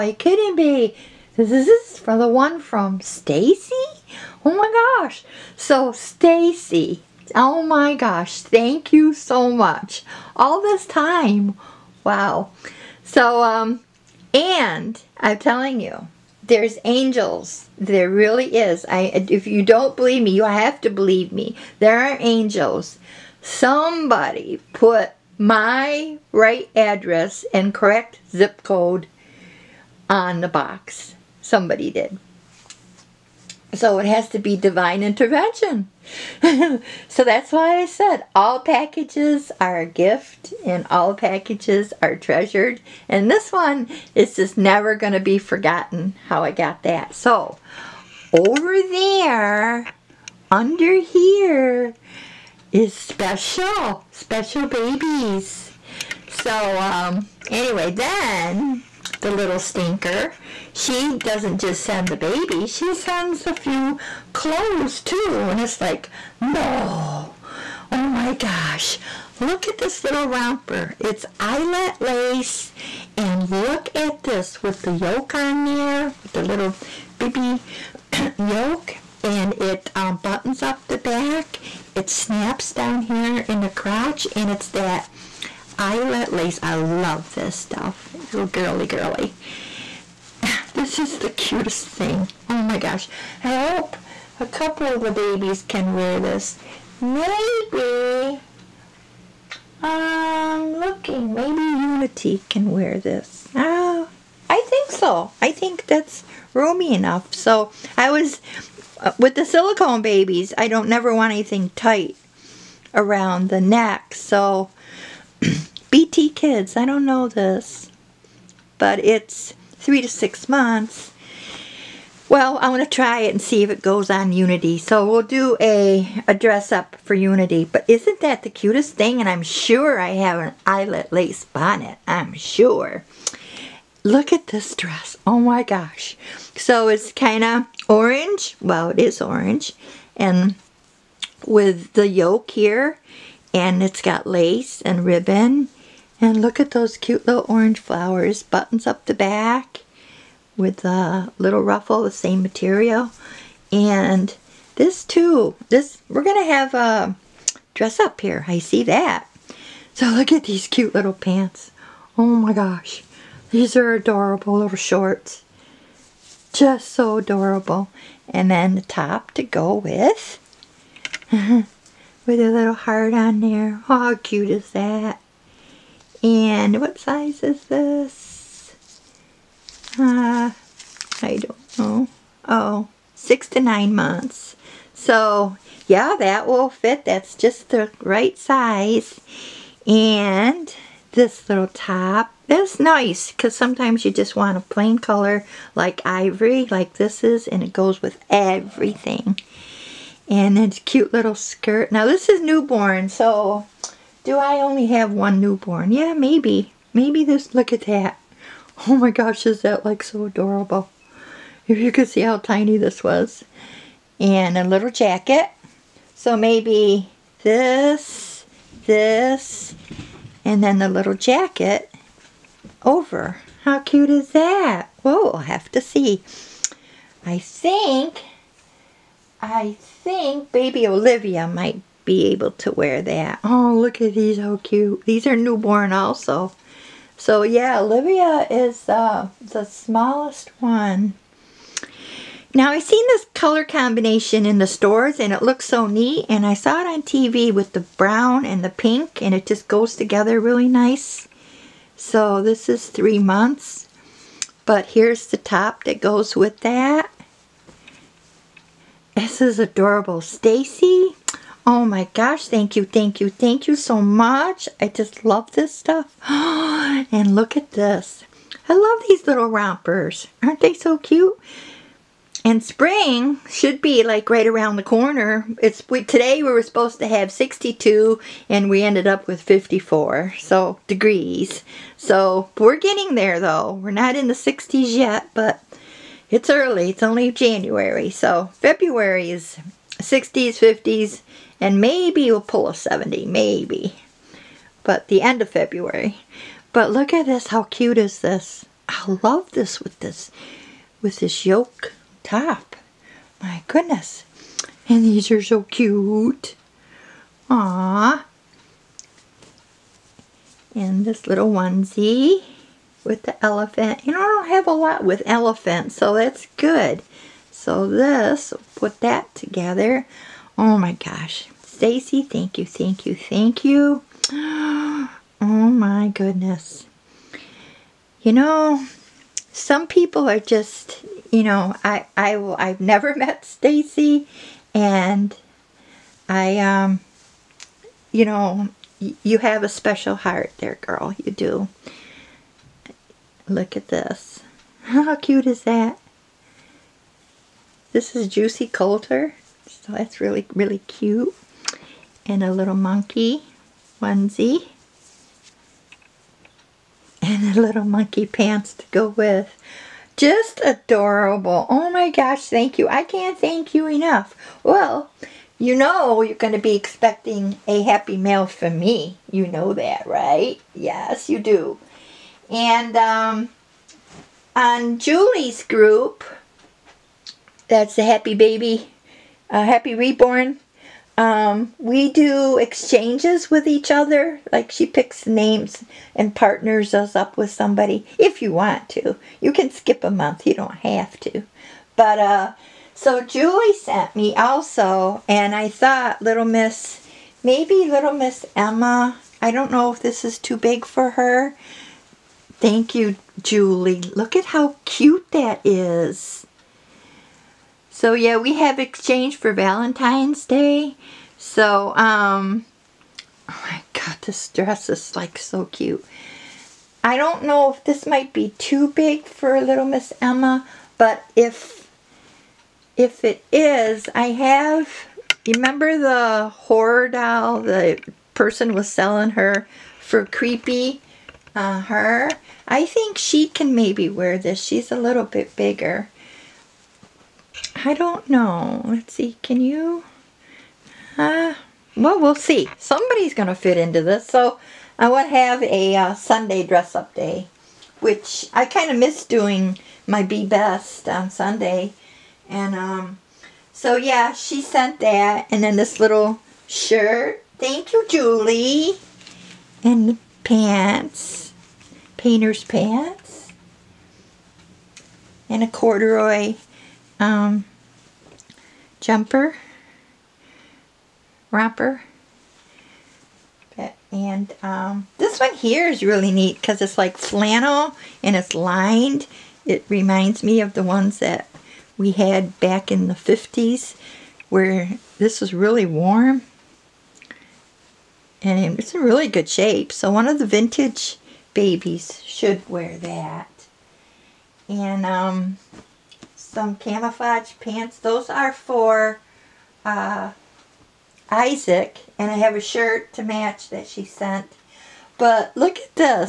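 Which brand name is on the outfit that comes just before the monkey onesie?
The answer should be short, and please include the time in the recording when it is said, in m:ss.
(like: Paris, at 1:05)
Juicy Couture, at 5:48.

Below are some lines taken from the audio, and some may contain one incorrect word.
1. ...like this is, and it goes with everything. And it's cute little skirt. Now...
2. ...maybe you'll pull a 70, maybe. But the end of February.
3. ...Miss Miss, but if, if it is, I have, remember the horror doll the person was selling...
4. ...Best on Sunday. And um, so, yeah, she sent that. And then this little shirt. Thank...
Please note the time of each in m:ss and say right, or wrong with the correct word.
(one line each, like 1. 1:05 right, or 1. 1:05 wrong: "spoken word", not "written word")
1. 3:16 right
2. 4:51 right
3. 6:59 wrong: "Emma", not "Miss"
4. 7:30 right.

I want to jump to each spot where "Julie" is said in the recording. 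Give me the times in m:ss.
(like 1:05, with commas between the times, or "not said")
6:14, 6:33, 6:43, 7:38.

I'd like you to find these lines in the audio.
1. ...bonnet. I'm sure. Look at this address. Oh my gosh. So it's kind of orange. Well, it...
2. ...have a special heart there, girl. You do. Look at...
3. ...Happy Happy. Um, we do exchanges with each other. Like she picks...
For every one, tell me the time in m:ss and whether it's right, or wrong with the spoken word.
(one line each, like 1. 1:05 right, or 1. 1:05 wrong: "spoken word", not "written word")
1. 2:11 wrong: "dress", not "address"
2. 5:39 right
3. 6:19 wrong: "Reborn", not "Happy".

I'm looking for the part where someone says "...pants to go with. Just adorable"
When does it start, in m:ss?
5:58.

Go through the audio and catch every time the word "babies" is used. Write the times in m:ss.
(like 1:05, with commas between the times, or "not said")
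0:54, 1:35, 1:50, 8:11.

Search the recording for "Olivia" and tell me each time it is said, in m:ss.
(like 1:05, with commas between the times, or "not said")
3:50, 3:57.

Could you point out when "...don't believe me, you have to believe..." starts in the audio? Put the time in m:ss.
0:19.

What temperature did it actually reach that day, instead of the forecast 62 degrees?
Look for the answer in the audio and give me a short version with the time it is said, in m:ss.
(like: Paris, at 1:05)
54, at 4:39.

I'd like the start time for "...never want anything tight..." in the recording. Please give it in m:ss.
1:50.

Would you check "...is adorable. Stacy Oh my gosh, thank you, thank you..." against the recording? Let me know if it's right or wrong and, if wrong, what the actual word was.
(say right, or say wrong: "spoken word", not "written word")
right.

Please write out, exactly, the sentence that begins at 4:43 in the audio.
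We're not in the 60s yet but it's early.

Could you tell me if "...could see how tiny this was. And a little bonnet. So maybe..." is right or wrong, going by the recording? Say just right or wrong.
wrong.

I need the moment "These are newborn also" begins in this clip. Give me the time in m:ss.
3:55.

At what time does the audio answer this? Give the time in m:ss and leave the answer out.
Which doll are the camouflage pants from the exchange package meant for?
8:21.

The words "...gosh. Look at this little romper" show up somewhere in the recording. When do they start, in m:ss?
1:08.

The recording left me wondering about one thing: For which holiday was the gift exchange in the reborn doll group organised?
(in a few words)
Valentine's Day.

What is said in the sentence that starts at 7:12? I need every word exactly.
I think she can maybe wear this.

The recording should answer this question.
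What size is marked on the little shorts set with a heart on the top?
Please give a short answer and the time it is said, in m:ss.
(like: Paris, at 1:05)
6 to 9 months, at 3:03.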